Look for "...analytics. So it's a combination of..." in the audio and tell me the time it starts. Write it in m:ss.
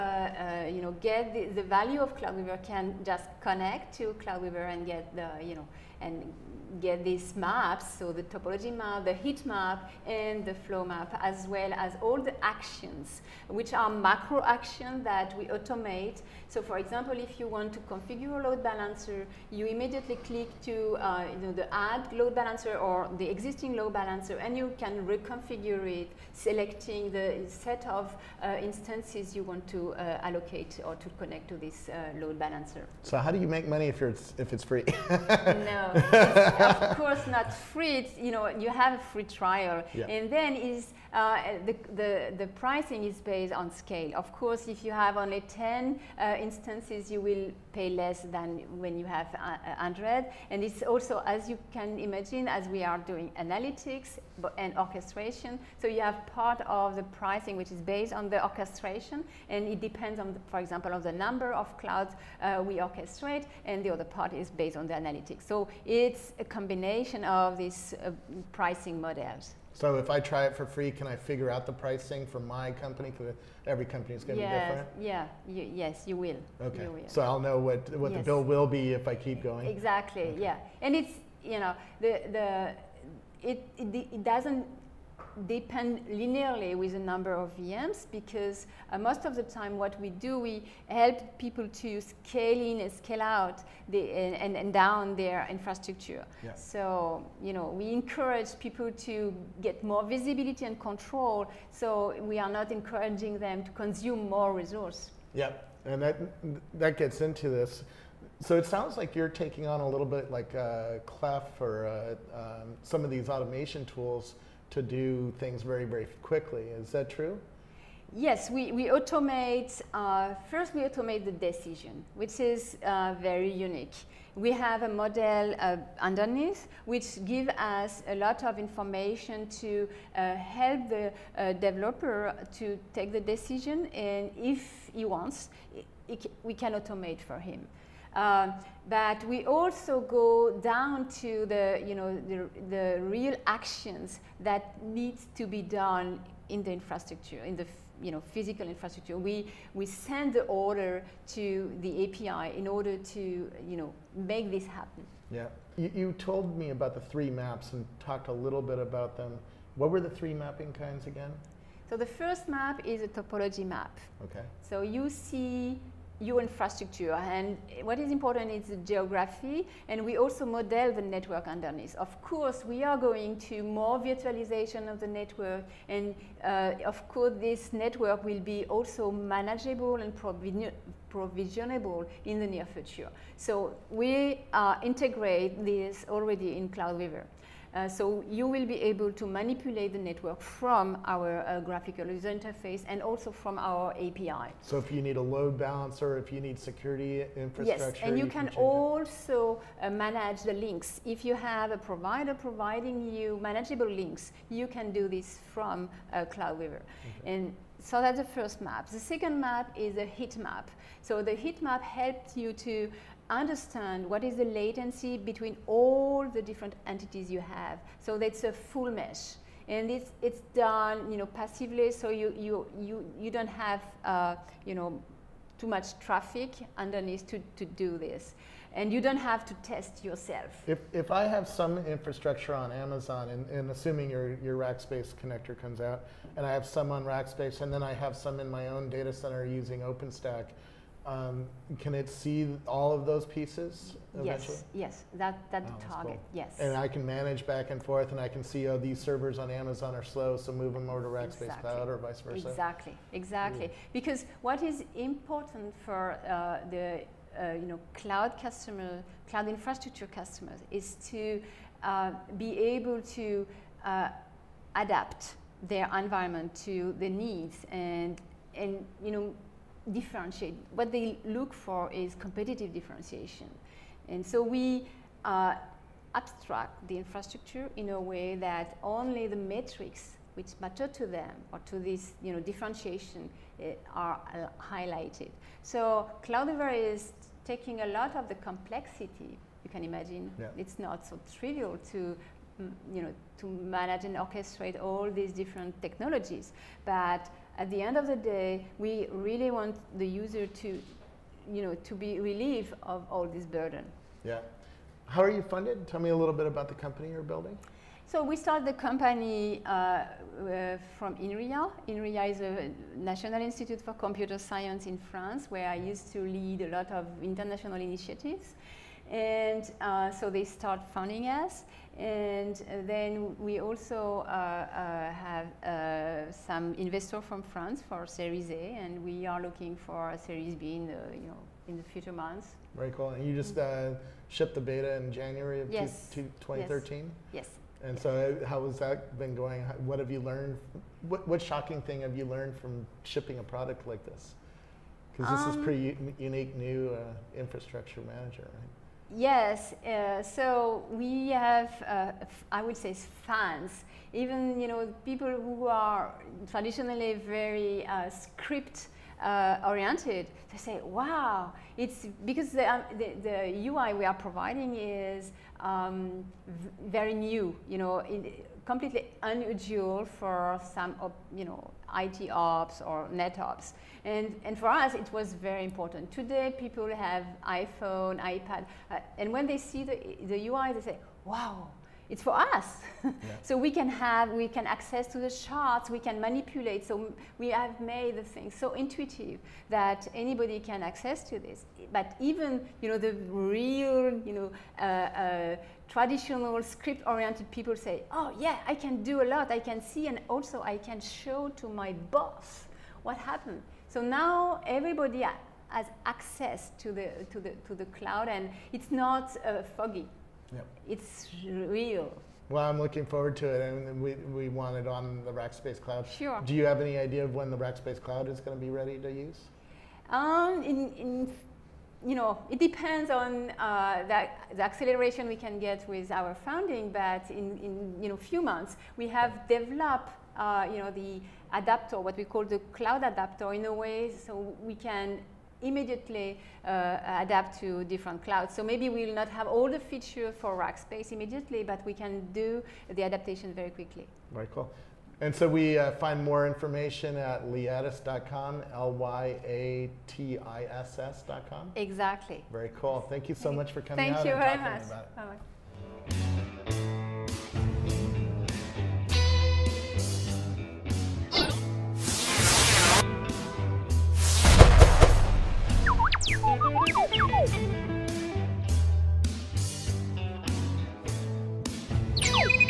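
1:04.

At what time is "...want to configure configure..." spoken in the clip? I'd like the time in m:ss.
0:17.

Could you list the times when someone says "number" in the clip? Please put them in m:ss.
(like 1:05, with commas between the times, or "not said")
1:01, 1:26.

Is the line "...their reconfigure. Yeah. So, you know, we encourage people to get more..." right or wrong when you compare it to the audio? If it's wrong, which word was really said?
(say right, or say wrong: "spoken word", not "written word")
wrong: "infrastructure", not "reconfigure".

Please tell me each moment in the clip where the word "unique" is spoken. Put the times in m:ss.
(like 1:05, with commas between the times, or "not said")
2:03, 5:46.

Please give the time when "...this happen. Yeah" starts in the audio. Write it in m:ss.
2:34.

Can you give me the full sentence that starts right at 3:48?
And you don't have to test yourself.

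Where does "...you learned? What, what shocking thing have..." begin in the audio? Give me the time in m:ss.
5:40.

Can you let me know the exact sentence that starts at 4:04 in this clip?
Yes, yes, that, that oh, target, cool.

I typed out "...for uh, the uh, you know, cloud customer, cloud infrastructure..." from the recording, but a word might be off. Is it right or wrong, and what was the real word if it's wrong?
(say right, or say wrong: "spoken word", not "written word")
right.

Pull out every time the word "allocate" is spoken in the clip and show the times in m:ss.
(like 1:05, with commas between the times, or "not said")
0:30.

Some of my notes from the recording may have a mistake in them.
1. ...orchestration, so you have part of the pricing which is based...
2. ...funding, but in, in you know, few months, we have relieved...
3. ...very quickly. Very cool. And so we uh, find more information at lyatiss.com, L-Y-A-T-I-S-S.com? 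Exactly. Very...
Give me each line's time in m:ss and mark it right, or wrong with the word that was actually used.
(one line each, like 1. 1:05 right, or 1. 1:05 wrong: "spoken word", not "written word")
1. 0:54 right
2. 7:06 wrong: "developed", not "relieved"
3. 7:23 right.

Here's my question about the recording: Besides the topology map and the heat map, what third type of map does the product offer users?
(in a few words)
flow map.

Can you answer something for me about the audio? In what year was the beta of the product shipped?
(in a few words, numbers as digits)
2013.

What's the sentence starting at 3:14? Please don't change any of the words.
So if you need a load balancer, if you need security infrastructure.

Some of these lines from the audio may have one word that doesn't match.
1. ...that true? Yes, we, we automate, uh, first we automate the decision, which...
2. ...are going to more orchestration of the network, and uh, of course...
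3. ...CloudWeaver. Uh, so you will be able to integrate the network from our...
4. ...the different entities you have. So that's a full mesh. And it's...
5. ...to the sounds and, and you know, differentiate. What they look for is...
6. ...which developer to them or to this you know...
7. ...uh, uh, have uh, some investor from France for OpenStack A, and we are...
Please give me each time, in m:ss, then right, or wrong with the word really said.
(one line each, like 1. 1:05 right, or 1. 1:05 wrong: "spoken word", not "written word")
1. 1:56 right
2. 2:52 wrong: "virtualization", not "orchestration"
3. 3:06 wrong: "manipulate", not "integrate"
4. 3:36 right
5. 4:26 wrong: "needs", not "sounds"
6. 4:40 wrong: "matter", not "developer"
7. 5:24 wrong: "Series", not "OpenStack".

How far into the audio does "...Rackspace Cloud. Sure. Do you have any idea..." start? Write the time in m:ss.
6:55.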